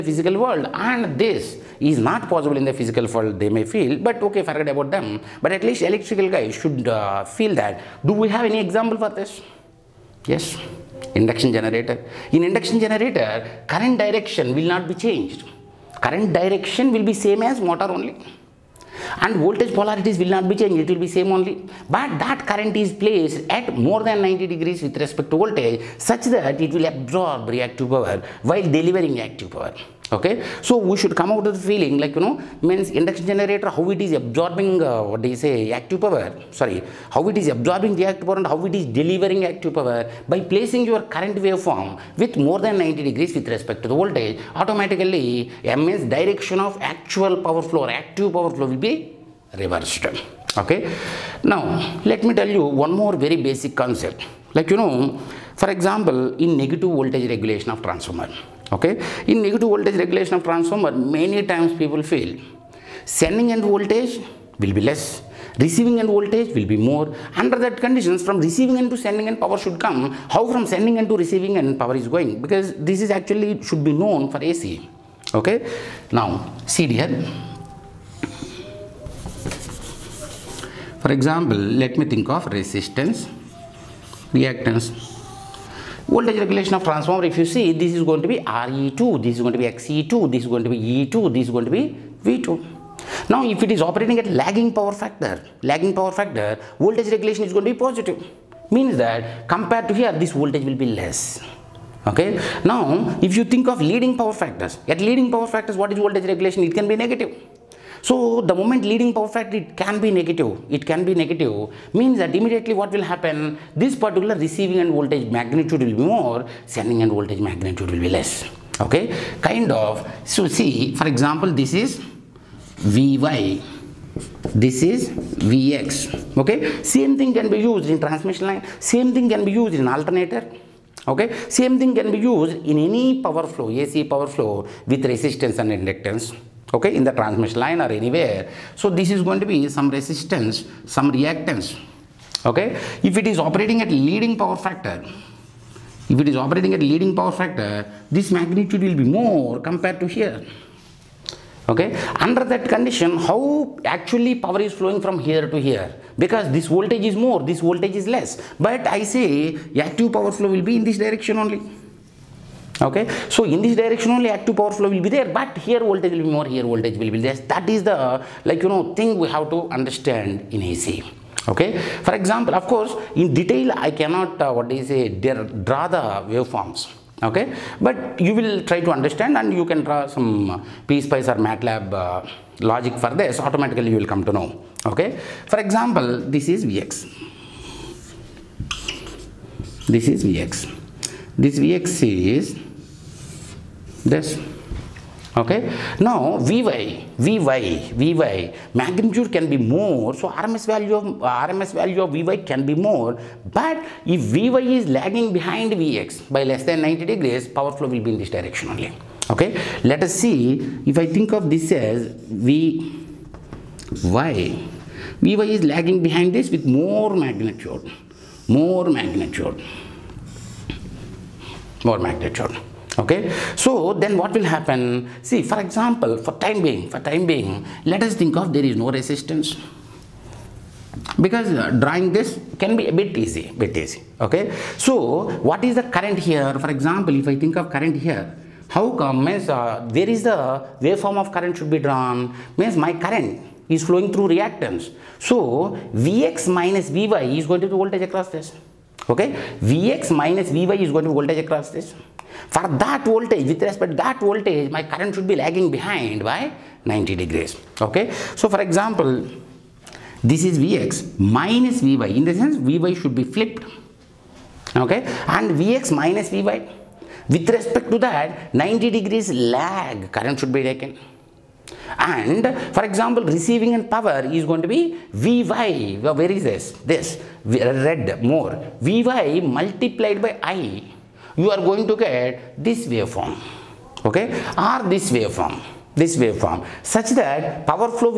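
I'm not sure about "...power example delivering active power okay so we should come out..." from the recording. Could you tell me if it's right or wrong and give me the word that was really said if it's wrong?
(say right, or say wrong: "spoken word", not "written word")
wrong: "while", not "example".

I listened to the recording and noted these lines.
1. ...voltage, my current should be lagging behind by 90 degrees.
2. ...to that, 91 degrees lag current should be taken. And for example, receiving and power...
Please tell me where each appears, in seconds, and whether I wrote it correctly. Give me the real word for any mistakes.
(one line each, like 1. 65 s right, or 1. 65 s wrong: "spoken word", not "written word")
1. 254 s right
2. 267 s wrong: "90", not "91".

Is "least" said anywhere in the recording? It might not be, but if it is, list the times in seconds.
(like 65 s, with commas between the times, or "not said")
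5 s.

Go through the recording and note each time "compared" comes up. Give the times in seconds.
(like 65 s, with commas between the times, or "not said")
99 s, 149 s.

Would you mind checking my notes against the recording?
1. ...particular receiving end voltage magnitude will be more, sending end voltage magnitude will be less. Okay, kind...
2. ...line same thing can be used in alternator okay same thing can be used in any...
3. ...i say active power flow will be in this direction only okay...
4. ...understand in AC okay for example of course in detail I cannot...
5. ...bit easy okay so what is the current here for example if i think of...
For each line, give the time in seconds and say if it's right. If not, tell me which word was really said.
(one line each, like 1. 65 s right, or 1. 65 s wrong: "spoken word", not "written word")
1. 114 s right
2. 128 s right
3. 158 s right
4. 169 s right
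5. 233 s right.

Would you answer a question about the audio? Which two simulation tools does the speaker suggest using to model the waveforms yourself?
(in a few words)
PSpice or MATLAB.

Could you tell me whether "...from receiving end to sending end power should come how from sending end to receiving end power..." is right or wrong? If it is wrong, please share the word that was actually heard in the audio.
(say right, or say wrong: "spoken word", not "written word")
right.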